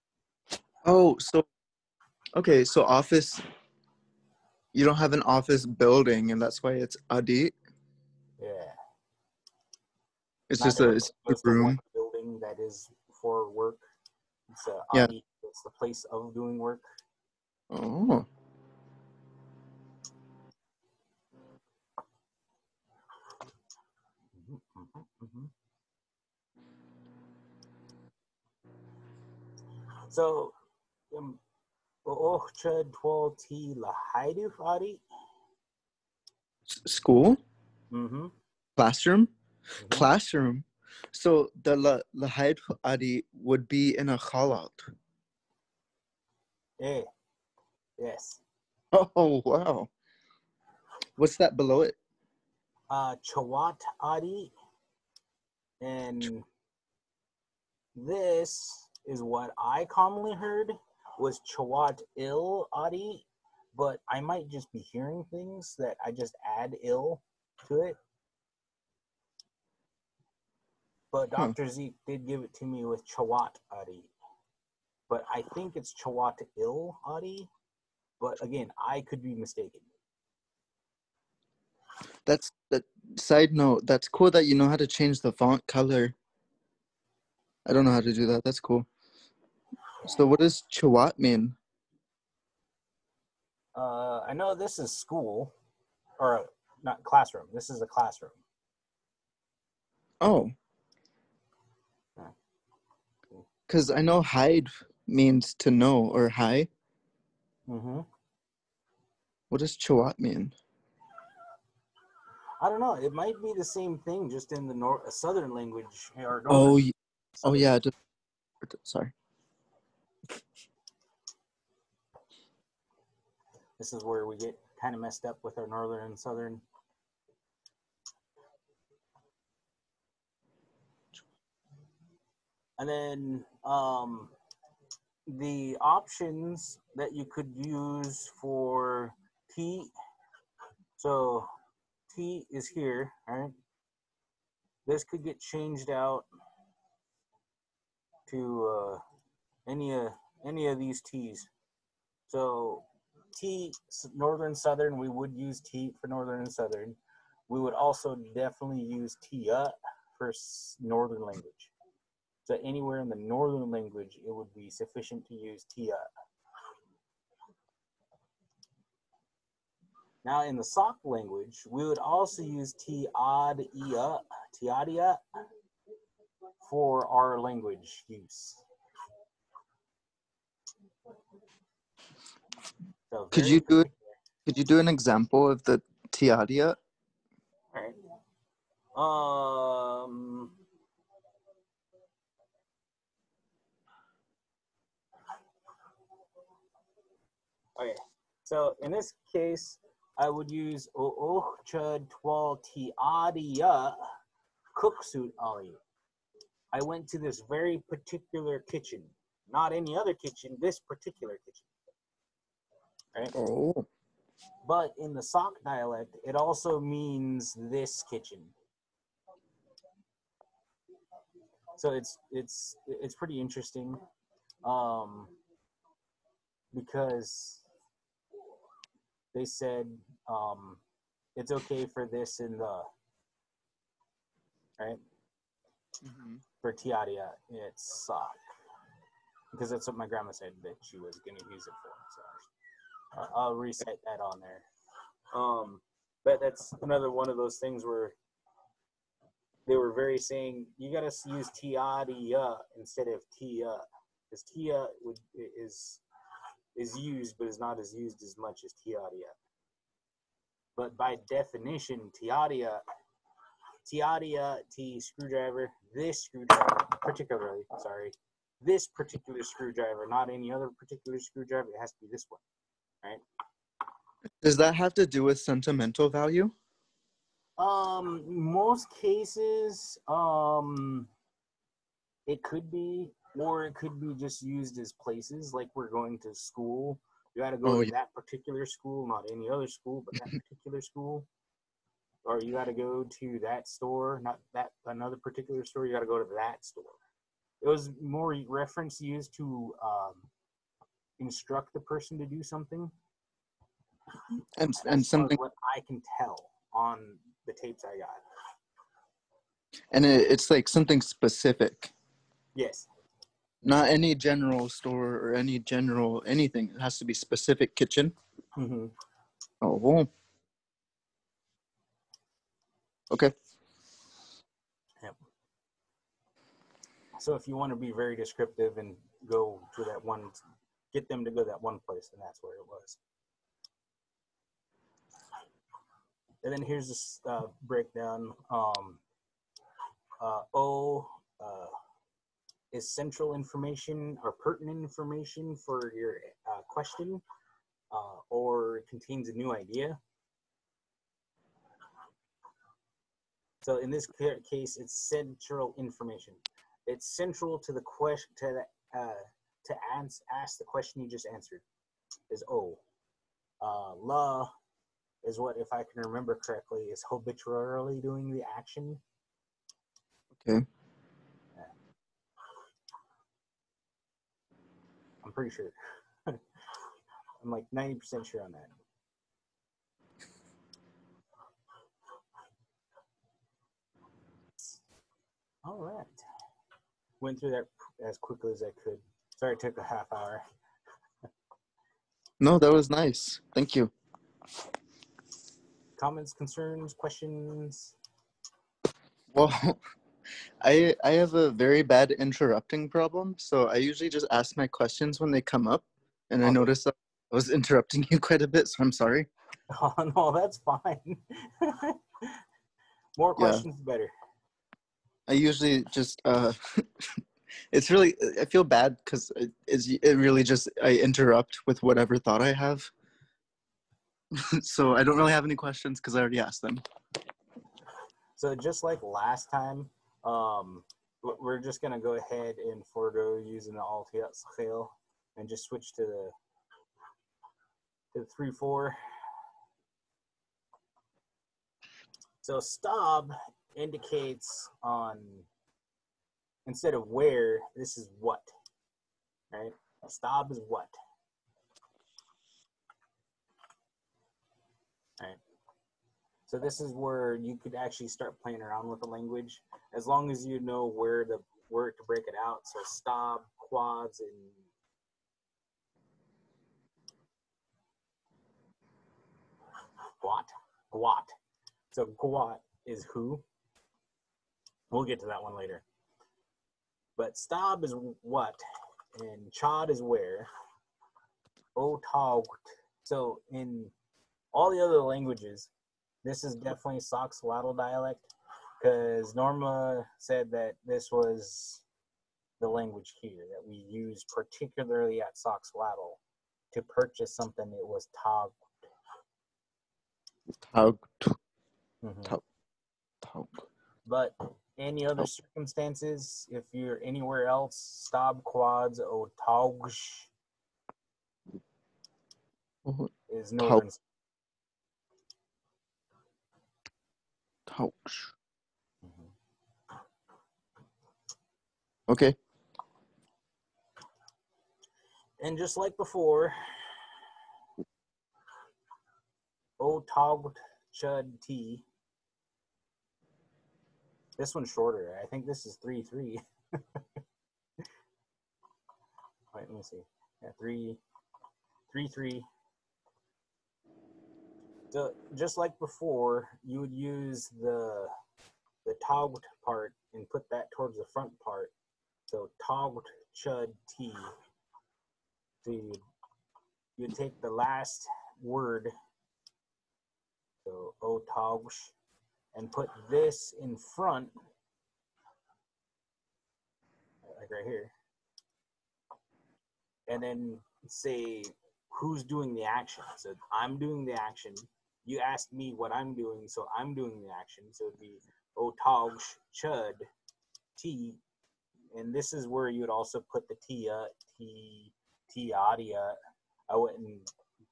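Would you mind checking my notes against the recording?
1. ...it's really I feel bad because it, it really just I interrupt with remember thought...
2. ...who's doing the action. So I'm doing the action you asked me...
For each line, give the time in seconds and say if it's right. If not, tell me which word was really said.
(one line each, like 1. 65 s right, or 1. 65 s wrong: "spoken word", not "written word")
1. 417 s wrong: "whatever", not "remember"
2. 571 s right.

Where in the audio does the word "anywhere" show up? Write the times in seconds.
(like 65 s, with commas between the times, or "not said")
162 s, 507 s.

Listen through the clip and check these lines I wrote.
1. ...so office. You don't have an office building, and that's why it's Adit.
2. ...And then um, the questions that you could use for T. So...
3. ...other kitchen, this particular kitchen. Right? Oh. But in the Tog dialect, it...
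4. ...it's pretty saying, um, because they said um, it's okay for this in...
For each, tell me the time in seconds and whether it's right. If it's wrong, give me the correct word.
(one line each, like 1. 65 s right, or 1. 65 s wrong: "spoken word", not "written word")
1. 2 s right
2. 132 s wrong: "options", not "questions"
3. 209 s wrong: "Sauk", not "Tog"
4. 222 s wrong: "interesting", not "saying".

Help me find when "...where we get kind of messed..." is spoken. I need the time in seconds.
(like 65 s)
124 s.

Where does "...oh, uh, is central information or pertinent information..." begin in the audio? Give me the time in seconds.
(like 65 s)
341 s.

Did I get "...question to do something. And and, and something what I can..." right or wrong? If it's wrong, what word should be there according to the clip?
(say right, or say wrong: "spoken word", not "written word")
wrong: "person", not "question".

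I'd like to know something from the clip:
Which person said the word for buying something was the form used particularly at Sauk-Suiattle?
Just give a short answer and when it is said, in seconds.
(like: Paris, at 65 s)
Norma, at 489 s.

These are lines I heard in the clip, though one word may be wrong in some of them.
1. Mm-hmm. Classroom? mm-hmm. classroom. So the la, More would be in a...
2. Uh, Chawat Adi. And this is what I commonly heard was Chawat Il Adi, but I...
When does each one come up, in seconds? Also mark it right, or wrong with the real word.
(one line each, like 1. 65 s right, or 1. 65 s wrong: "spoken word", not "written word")
1. 37 s wrong: "Adi", not "More"
2. 52 s right.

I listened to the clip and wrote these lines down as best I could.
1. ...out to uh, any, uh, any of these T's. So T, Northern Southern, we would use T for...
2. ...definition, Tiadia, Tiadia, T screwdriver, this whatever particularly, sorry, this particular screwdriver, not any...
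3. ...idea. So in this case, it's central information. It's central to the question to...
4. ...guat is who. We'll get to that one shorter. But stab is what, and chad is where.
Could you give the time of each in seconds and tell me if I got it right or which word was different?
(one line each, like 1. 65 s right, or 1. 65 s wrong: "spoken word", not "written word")
1. 145 s right
2. 261 s wrong: "screwdriver", not "whatever"
3. 349 s right
4. 472 s wrong: "later", not "shorter".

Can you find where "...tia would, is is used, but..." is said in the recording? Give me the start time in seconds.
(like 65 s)
254 s.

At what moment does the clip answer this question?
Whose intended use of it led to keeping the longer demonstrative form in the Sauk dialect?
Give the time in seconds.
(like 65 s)
239 s.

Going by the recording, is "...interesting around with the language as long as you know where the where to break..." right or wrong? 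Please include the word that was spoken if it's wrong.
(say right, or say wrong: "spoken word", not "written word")
wrong: "playing", not "interesting".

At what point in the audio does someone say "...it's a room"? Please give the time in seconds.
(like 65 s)
10 s.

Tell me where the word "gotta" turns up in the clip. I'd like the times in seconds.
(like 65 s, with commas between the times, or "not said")
not said.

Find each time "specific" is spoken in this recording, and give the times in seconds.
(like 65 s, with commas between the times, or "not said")
311 s, 317 s.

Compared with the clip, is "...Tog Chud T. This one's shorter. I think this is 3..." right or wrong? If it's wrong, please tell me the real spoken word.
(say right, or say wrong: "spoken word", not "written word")
right.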